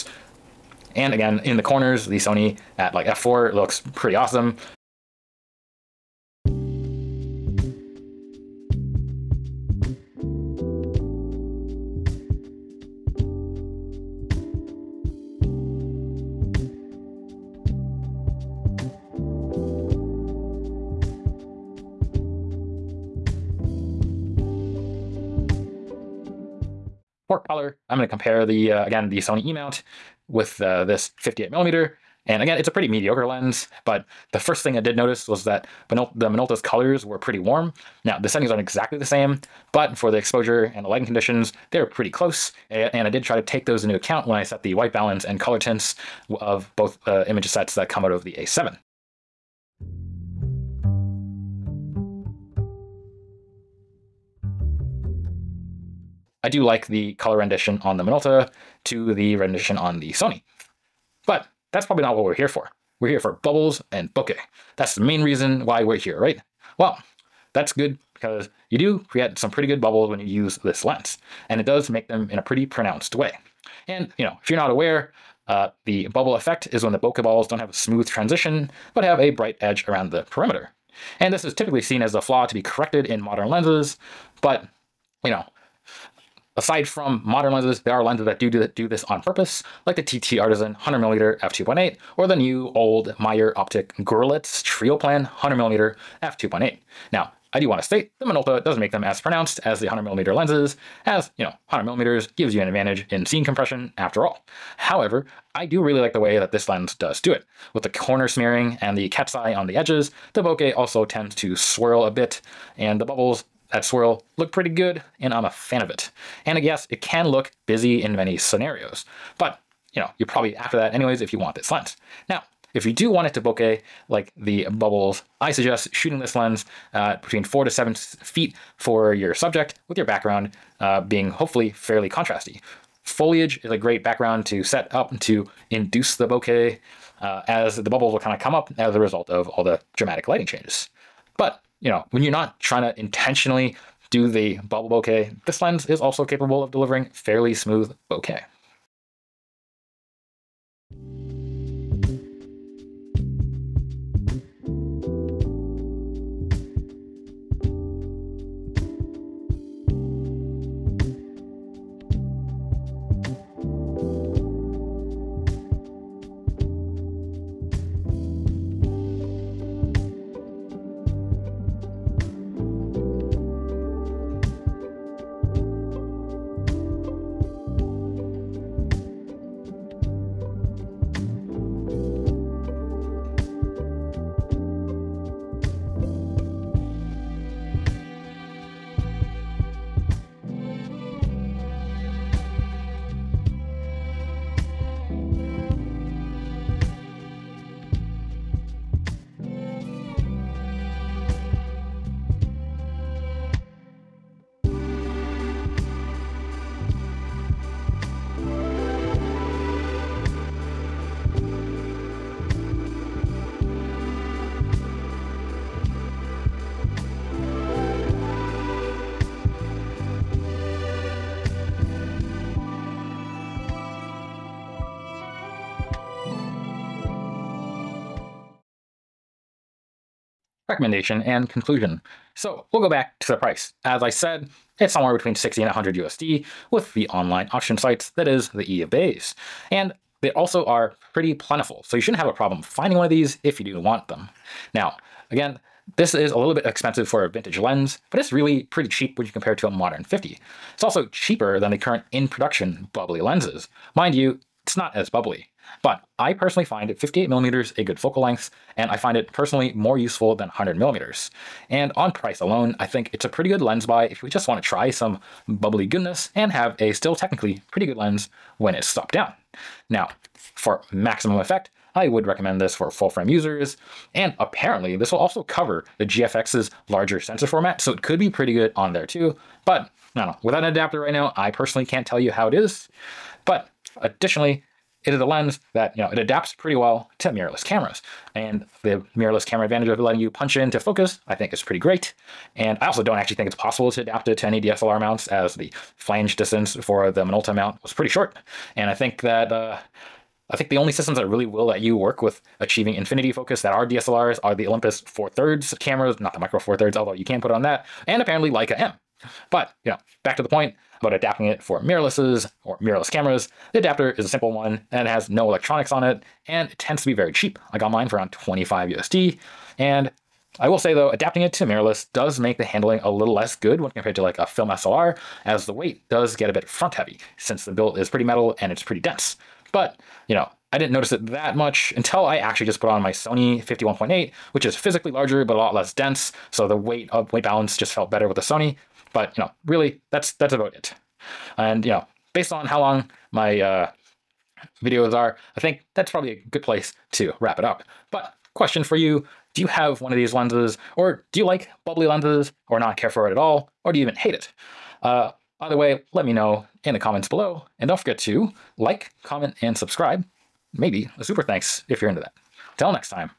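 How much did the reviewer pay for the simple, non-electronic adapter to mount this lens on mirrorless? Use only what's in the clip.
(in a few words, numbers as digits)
25 USD.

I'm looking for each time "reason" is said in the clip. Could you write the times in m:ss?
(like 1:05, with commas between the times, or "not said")
1:05.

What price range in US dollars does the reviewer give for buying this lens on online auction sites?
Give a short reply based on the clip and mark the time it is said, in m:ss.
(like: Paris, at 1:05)
60 to 100 USD, at 3:55.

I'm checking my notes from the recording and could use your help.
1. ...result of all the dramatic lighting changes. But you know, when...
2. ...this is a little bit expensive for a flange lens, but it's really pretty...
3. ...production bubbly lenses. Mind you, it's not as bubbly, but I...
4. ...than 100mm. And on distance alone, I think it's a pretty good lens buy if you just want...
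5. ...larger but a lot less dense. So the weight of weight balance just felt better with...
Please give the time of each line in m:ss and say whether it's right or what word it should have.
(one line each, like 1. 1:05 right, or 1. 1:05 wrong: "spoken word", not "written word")
1. 2:18 right
2. 4:05 wrong: "vintage", not "flange"
3. 4:12 right
4. 4:20 wrong: "price", not "distance"
5. 5:35 right.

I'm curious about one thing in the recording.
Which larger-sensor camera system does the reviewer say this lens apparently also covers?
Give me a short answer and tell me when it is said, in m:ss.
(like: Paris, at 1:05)
GFX, at 4:36.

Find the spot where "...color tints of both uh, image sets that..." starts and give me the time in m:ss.
0:45.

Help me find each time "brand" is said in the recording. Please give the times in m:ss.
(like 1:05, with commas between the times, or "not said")
not said.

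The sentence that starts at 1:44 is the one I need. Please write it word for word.
However, I do really like the way that this lens does do it.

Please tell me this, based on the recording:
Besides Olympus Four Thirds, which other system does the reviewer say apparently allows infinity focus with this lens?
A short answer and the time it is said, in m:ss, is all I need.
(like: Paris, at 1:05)
Leica M, at 5:08.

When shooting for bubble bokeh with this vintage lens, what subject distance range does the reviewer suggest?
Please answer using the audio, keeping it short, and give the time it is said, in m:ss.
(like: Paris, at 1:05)
4 to 7 feet, at 2:07.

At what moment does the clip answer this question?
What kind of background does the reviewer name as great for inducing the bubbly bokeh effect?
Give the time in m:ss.
2:13.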